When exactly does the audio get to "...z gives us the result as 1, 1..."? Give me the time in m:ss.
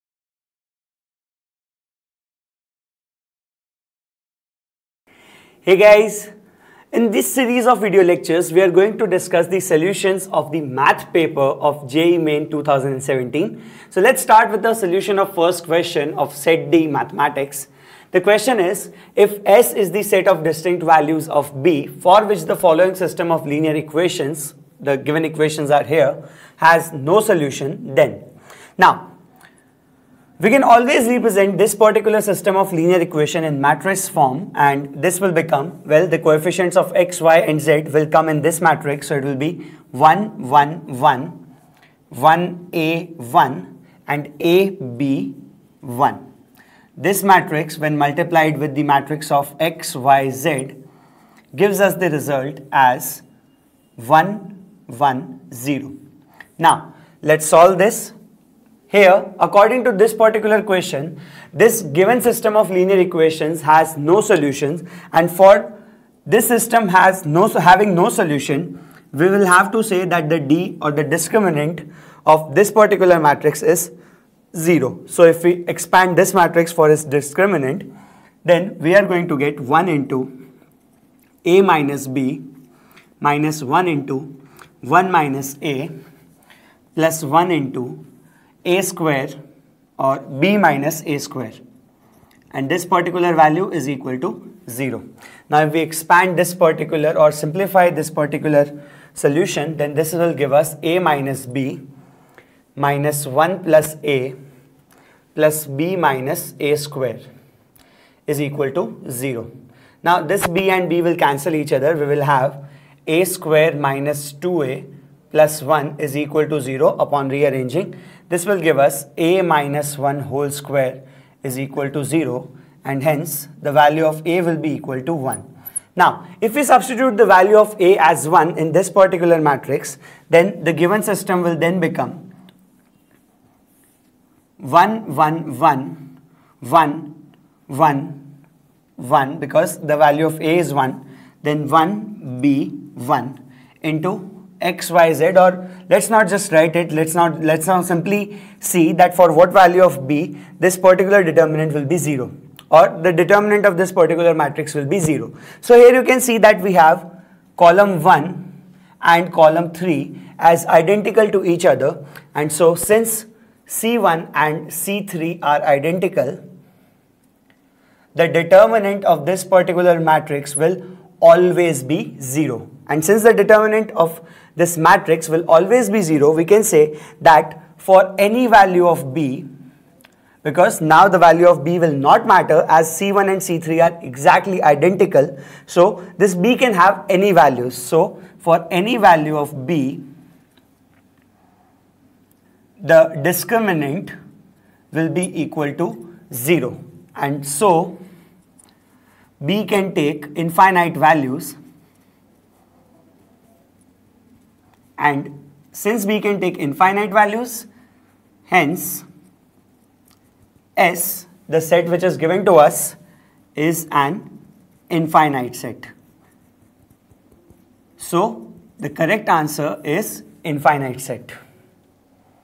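0:50.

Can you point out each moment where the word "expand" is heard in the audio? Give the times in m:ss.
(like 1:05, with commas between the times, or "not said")
1:15, 1:35.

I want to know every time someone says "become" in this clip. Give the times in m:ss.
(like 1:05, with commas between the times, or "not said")
0:35, 2:11.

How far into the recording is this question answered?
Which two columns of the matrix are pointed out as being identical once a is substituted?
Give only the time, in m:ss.
2:37.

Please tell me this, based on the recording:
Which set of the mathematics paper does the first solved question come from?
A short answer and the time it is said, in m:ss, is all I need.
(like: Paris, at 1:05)
Set D, at 0:16.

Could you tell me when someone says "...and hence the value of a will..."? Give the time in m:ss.
2:02.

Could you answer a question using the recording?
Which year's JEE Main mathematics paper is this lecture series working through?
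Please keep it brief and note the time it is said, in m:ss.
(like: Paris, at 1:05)
2017, at 0:12.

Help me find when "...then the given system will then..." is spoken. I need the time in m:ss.
2:10.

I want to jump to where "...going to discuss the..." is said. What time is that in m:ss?
0:08.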